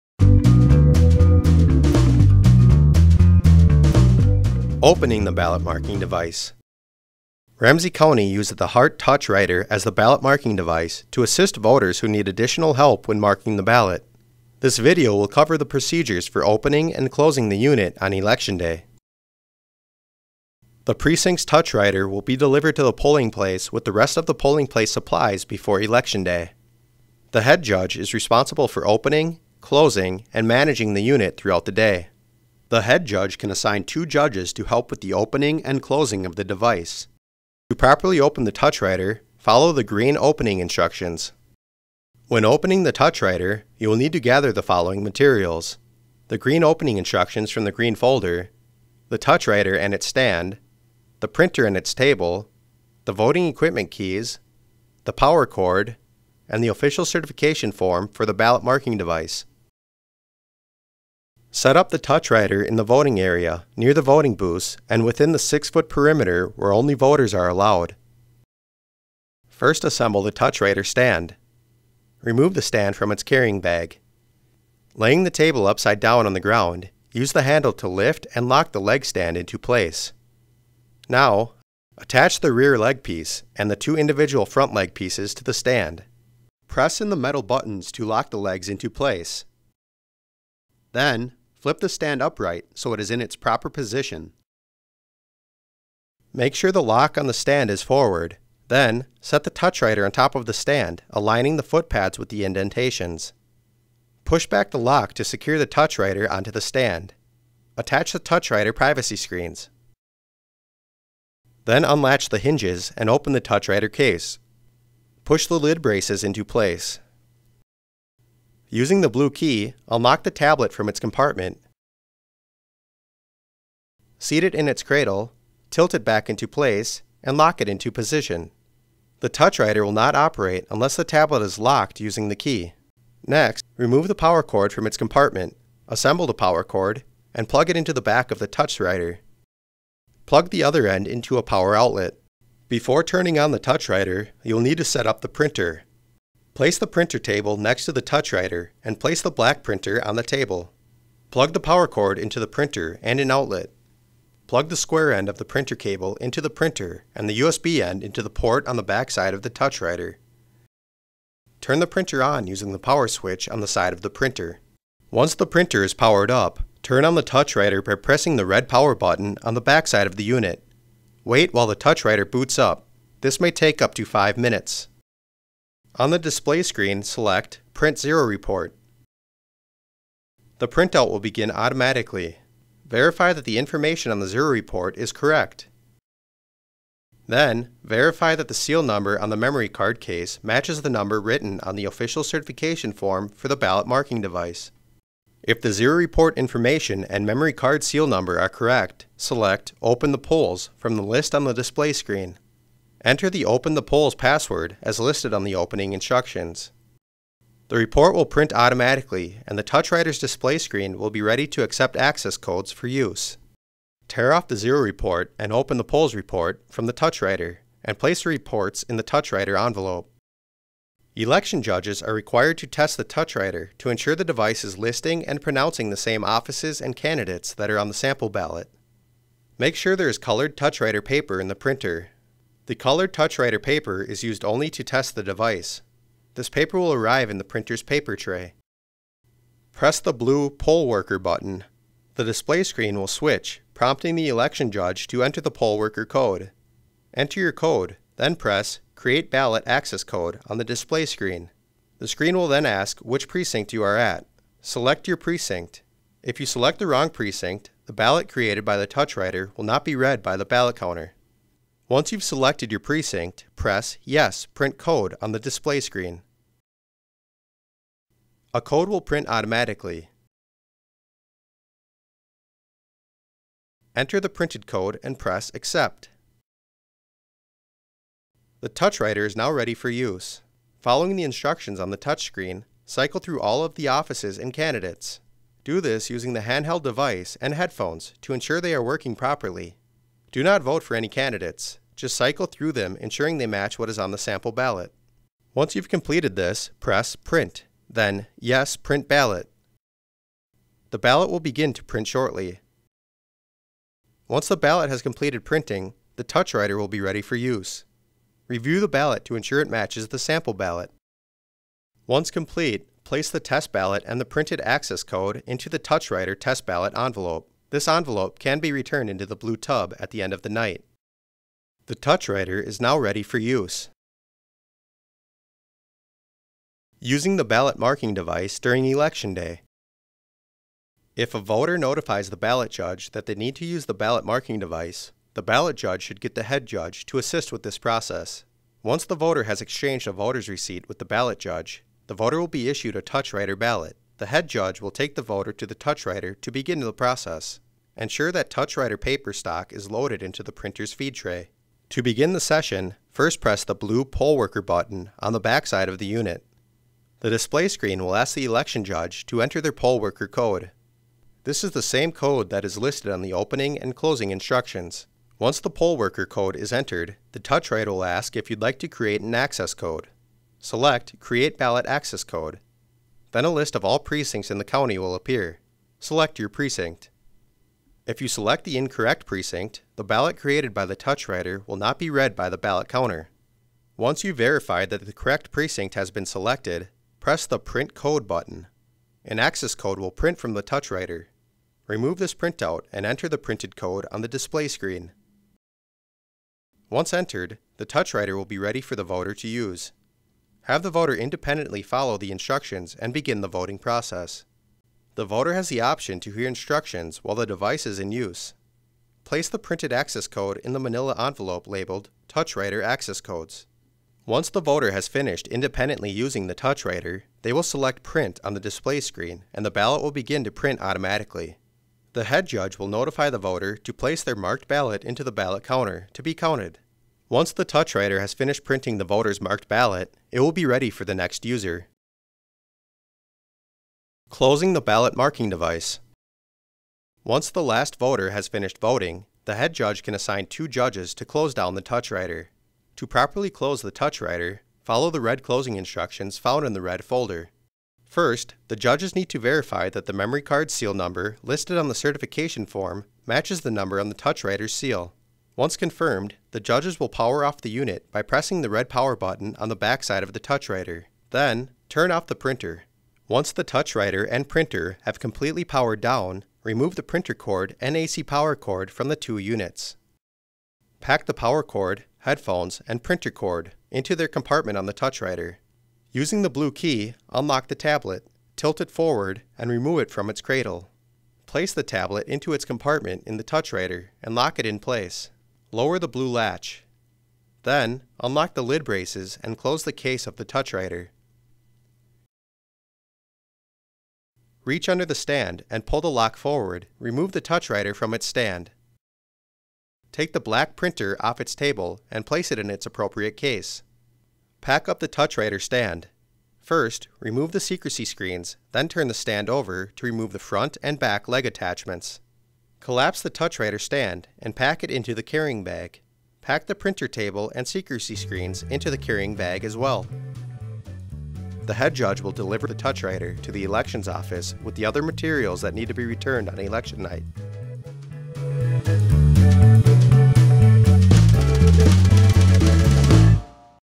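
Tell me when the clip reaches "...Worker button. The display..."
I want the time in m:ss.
4:00.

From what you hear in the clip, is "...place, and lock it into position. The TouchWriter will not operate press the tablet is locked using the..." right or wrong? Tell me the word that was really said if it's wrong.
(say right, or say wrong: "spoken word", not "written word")
wrong: "unless", not "press".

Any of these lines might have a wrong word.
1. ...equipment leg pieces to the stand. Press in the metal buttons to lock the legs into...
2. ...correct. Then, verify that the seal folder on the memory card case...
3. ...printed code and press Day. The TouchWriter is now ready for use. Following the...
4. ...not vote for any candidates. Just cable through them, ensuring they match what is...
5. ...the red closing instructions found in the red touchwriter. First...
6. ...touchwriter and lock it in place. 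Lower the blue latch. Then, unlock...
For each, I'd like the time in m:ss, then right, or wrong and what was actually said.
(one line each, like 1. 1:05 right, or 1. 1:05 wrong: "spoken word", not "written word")
1. 1:24 wrong: "front", not "equipment"
2. 3:05 wrong: "number", not "folder"
3. 4:34 wrong: "Accept", not "Day"
4. 4:50 wrong: "cycle", not "cable"
5. 7:25 wrong: "folder", not "touchwriter"
6. 8:03 right.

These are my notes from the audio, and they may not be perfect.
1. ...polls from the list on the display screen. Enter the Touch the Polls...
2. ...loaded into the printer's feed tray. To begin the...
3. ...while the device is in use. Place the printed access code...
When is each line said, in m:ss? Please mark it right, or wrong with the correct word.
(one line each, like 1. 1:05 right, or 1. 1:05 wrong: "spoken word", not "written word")
1. 3:20 wrong: "Open", not "Touch"
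2. 5:49 right
3. 6:47 right.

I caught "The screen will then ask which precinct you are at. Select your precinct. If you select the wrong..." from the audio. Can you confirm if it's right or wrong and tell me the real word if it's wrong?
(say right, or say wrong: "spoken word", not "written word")
right.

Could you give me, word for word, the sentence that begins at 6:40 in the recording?
Have the voter independently follow the instructions and begin the voting process.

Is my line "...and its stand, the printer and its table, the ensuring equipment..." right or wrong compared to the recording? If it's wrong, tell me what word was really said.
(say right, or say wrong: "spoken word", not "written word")
wrong: "voting", not "ensuring".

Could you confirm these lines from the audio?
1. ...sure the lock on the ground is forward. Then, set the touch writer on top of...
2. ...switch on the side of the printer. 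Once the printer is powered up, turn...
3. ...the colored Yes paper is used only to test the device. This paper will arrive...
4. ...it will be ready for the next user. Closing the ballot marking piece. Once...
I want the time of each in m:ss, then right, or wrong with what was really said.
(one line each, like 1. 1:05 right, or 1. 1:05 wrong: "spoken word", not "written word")
1. 1:36 wrong: "stand", not "ground"
2. 2:43 right
3. 3:52 wrong: "TouchWriter", not "Yes"
4. 7:10 wrong: "device", not "piece".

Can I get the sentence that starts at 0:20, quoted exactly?
The precinct's touch writer will be delivered to the polling place with the rest of the polling place supplies before Election Day.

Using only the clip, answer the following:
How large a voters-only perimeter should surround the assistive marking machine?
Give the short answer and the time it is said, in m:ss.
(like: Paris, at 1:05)
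6 foot, at 1:05.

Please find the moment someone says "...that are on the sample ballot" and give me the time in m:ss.
3:47.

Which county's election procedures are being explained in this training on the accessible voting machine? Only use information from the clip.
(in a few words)
Ramsey County.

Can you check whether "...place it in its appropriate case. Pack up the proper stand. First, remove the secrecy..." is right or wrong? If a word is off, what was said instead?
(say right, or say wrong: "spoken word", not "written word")
wrong: "touchwriter", not "proper".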